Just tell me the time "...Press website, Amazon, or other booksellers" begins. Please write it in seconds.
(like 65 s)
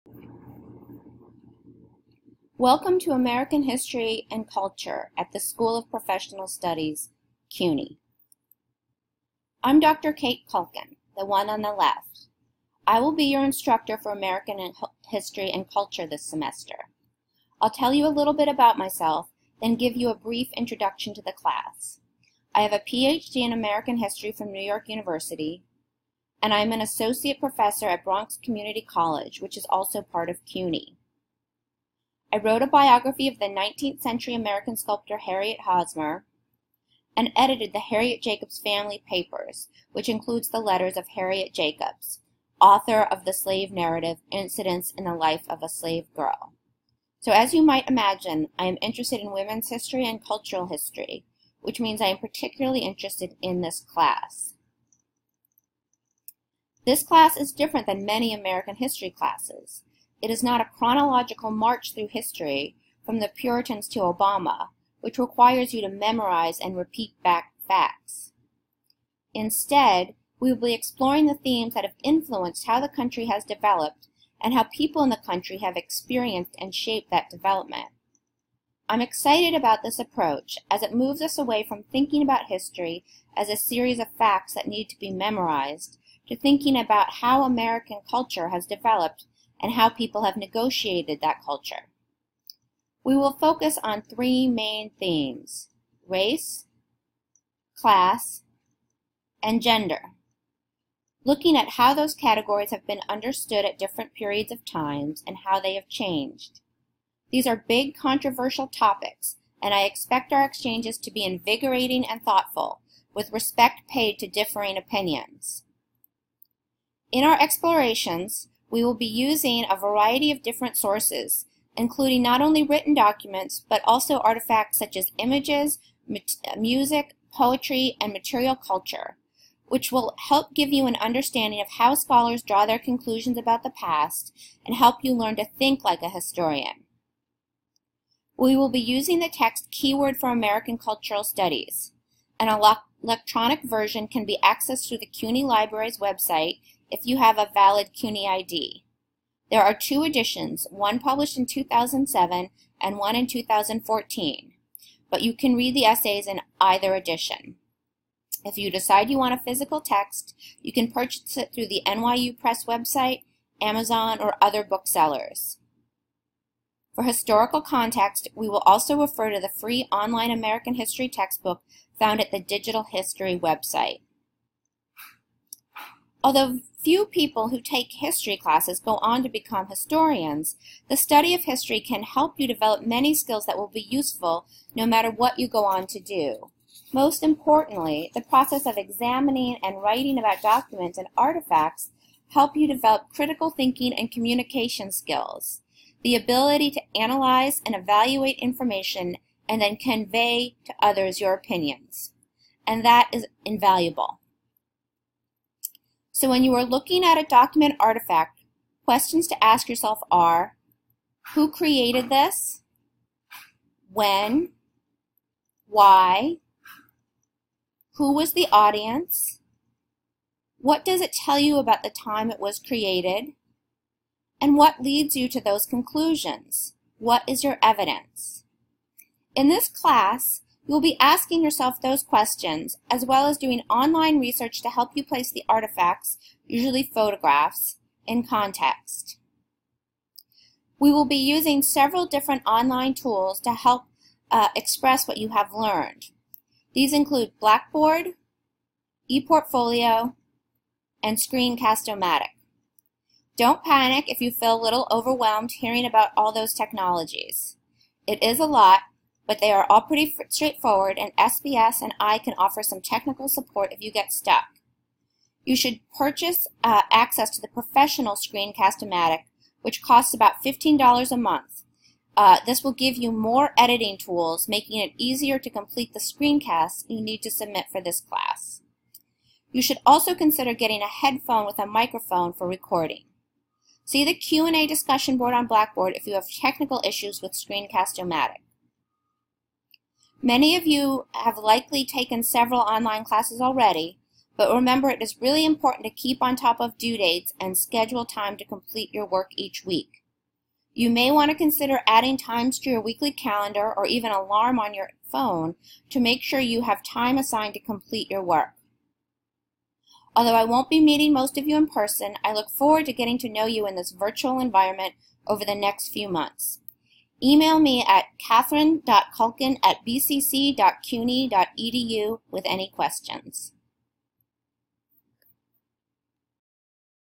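162 s.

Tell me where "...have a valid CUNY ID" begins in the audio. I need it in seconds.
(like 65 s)
147 s.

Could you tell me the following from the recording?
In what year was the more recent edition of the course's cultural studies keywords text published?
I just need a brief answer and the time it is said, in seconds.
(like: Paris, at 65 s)
2014, at 153 s.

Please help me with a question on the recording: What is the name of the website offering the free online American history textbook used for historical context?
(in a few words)
Digital History.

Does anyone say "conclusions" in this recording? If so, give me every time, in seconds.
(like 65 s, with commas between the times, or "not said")
132 s, 225 s.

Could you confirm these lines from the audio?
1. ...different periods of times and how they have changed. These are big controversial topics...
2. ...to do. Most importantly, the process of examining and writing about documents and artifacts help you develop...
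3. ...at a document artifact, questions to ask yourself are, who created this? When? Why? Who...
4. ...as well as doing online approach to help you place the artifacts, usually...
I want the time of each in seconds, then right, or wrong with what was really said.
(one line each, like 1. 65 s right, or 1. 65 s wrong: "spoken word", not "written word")
1. 103 s right
2. 185 s right
3. 207 s right
4. 232 s wrong: "research", not "approach".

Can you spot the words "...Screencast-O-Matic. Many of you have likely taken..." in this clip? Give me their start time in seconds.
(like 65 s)
287 s.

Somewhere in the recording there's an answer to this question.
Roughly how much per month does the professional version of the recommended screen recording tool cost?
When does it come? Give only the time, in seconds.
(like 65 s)
270 s.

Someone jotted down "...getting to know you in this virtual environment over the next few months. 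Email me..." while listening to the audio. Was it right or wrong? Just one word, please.
right.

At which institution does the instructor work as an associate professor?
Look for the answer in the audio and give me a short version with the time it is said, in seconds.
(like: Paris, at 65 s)
Bronx Community College, at 28 s.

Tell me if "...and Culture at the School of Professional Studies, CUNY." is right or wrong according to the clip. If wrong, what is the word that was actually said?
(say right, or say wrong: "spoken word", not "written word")
right.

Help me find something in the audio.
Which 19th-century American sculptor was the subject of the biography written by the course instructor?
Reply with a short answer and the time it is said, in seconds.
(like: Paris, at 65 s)
Harriet Hosmer, at 35 s.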